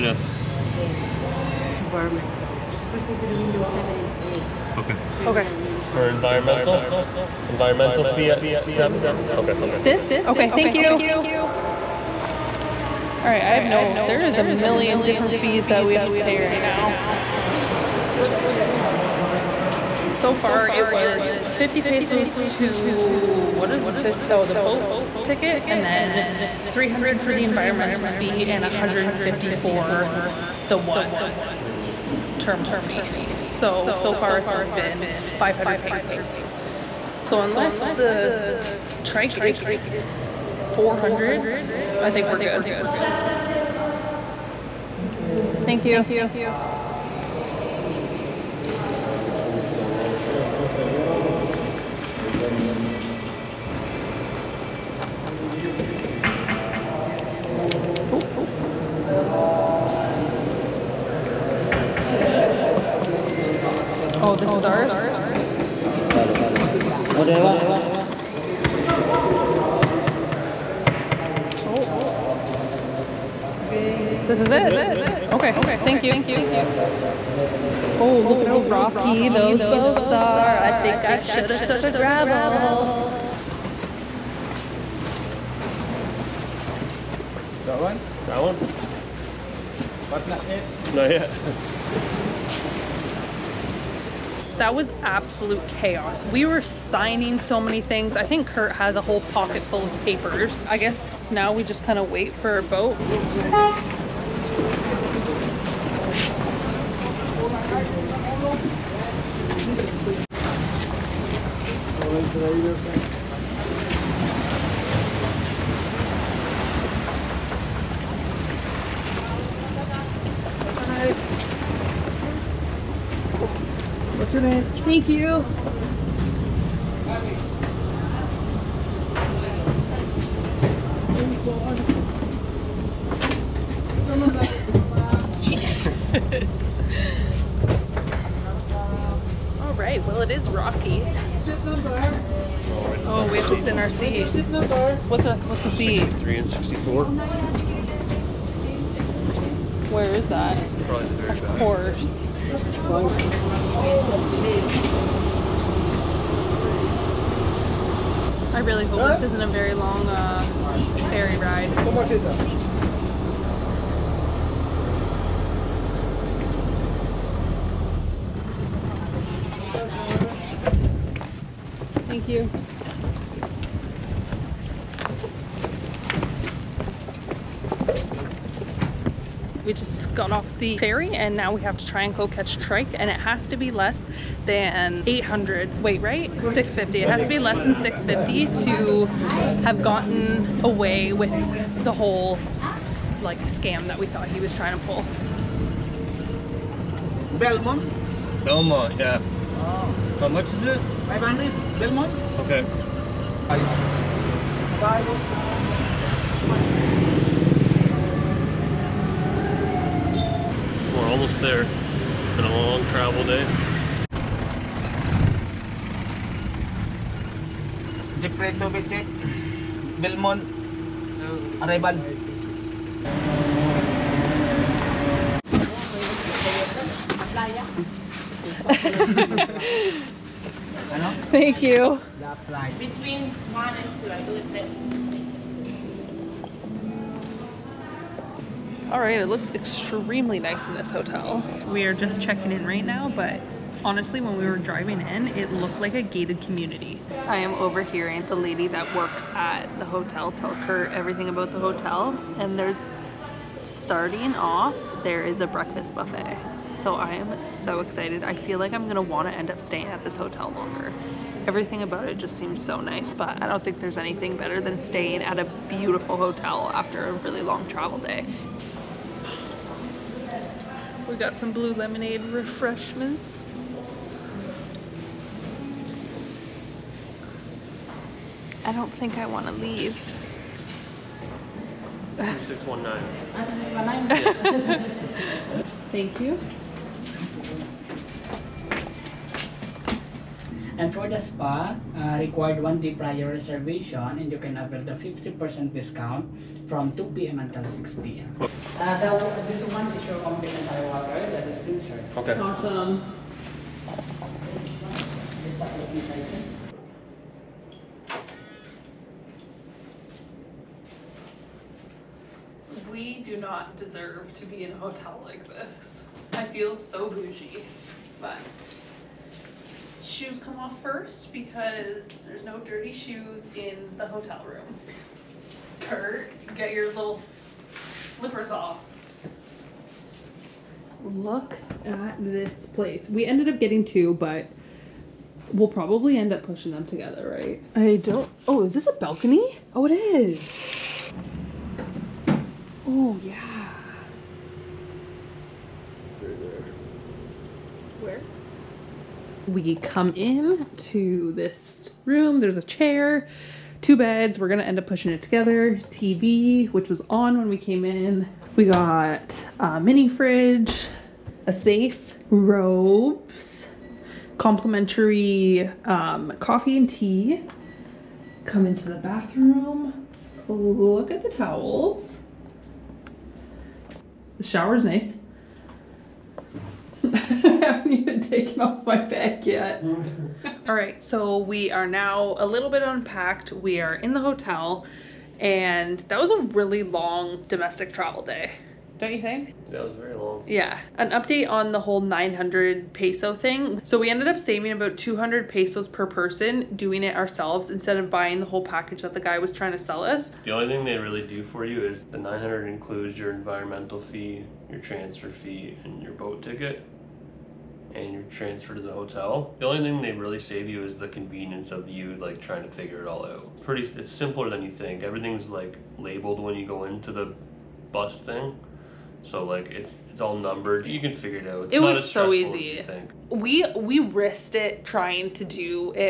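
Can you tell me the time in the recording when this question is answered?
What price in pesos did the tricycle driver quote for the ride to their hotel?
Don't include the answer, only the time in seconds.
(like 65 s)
201 s.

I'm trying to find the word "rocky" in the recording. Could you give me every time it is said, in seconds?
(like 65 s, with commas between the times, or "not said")
78 s, 140 s.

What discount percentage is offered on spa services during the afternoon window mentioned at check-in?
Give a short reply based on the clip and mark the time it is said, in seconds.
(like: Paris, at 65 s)
50%, at 294 s.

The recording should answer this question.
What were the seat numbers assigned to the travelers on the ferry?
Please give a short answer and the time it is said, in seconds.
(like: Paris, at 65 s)
63 and 64, at 145 s.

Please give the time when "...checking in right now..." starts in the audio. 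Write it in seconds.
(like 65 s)
242 s.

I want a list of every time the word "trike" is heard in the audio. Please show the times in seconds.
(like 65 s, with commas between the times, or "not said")
39 s, 182 s.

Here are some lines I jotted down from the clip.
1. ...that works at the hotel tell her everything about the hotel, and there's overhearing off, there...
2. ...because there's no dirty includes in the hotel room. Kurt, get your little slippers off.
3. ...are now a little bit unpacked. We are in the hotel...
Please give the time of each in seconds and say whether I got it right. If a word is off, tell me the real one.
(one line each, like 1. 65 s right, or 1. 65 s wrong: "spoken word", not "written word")
1. 248 s wrong: "starting", not "overhearing"
2. 321 s wrong: "shoes", not "includes"
3. 381 s right.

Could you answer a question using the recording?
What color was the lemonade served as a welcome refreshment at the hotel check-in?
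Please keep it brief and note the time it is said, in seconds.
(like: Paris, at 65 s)
Blue, at 271 s.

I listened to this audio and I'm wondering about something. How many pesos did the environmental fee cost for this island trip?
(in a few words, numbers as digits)
300.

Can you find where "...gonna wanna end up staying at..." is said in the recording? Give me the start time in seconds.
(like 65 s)
258 s.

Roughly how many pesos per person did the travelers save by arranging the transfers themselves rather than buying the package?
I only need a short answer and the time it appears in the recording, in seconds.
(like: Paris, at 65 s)
200, at 394 s.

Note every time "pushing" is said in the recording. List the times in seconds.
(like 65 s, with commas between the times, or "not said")
336 s, 354 s.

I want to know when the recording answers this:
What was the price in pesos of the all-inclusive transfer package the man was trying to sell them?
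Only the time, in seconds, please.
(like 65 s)
392 s.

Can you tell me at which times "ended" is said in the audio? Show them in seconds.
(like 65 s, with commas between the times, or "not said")
333 s, 394 s.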